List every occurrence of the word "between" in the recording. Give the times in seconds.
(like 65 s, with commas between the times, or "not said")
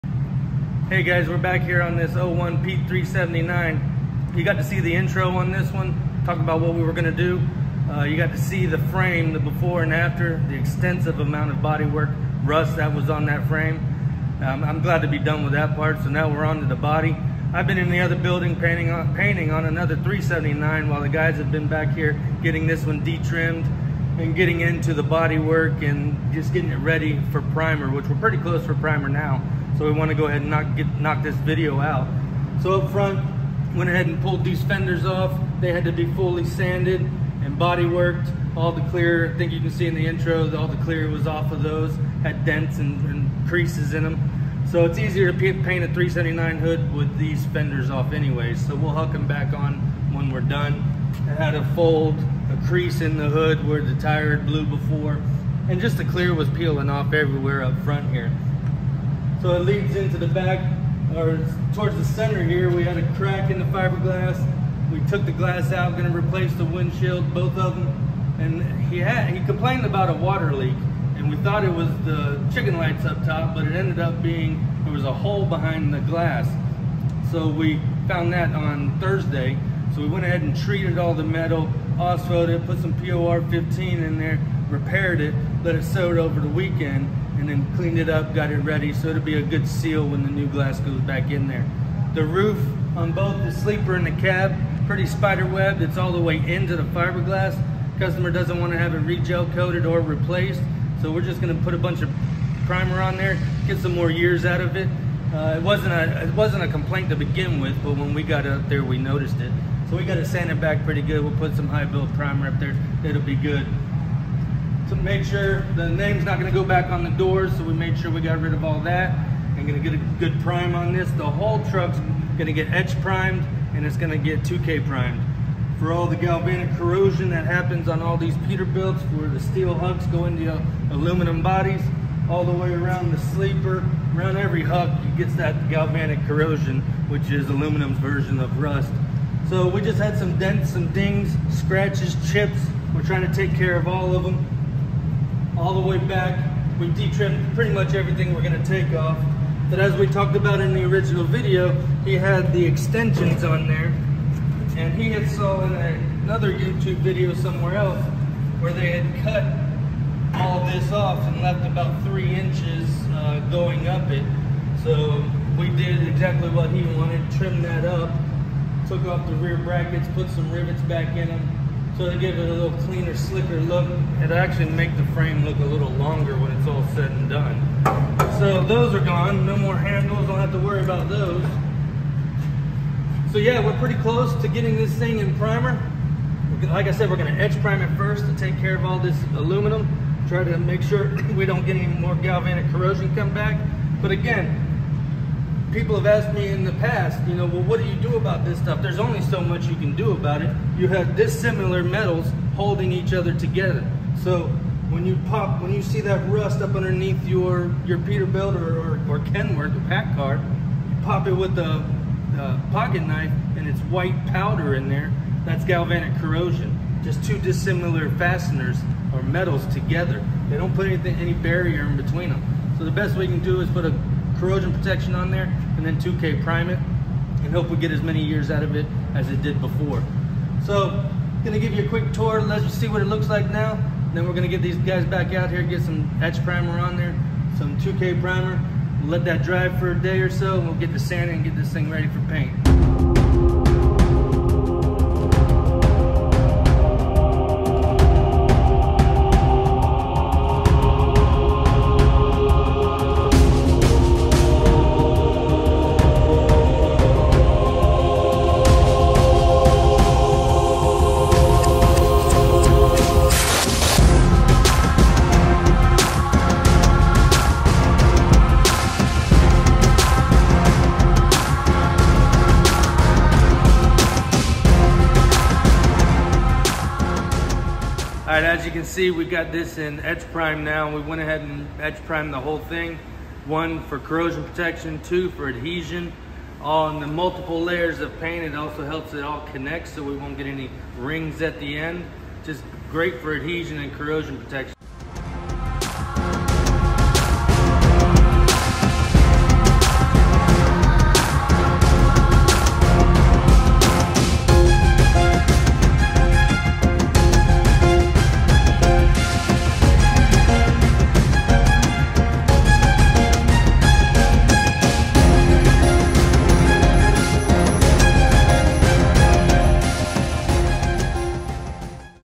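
221 s.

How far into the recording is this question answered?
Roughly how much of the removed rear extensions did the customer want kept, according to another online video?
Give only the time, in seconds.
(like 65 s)
162 s.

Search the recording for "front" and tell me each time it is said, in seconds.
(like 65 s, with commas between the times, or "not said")
32 s, 57 s.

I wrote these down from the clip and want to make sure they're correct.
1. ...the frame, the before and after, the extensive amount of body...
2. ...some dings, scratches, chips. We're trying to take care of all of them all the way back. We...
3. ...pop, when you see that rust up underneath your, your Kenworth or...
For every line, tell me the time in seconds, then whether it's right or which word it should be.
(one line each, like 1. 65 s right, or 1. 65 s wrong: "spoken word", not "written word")
1. 8 s right
2. 140 s right
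3. 205 s wrong: "Peterbilt", not "Kenworth".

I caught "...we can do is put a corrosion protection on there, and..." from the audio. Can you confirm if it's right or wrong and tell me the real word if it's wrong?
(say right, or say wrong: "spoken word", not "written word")
right.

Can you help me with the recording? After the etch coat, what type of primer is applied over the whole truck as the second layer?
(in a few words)
2K primer.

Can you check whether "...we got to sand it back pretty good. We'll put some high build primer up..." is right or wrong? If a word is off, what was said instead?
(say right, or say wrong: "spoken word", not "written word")
right.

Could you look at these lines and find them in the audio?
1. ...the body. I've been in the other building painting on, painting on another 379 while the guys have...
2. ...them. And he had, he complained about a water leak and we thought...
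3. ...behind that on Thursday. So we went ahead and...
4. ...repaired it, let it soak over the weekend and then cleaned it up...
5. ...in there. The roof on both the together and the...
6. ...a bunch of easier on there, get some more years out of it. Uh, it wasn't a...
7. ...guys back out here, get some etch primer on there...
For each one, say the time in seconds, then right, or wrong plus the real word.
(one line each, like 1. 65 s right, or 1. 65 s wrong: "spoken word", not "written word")
1. 16 s right
2. 67 s right
3. 78 s wrong: "found", not "behind"
4. 84 s right
5. 91 s wrong: "sleeper", not "together"
6. 101 s wrong: "primer", not "easier"
7. 234 s right.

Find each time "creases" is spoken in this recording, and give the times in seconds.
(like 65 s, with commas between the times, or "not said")
43 s, 52 s.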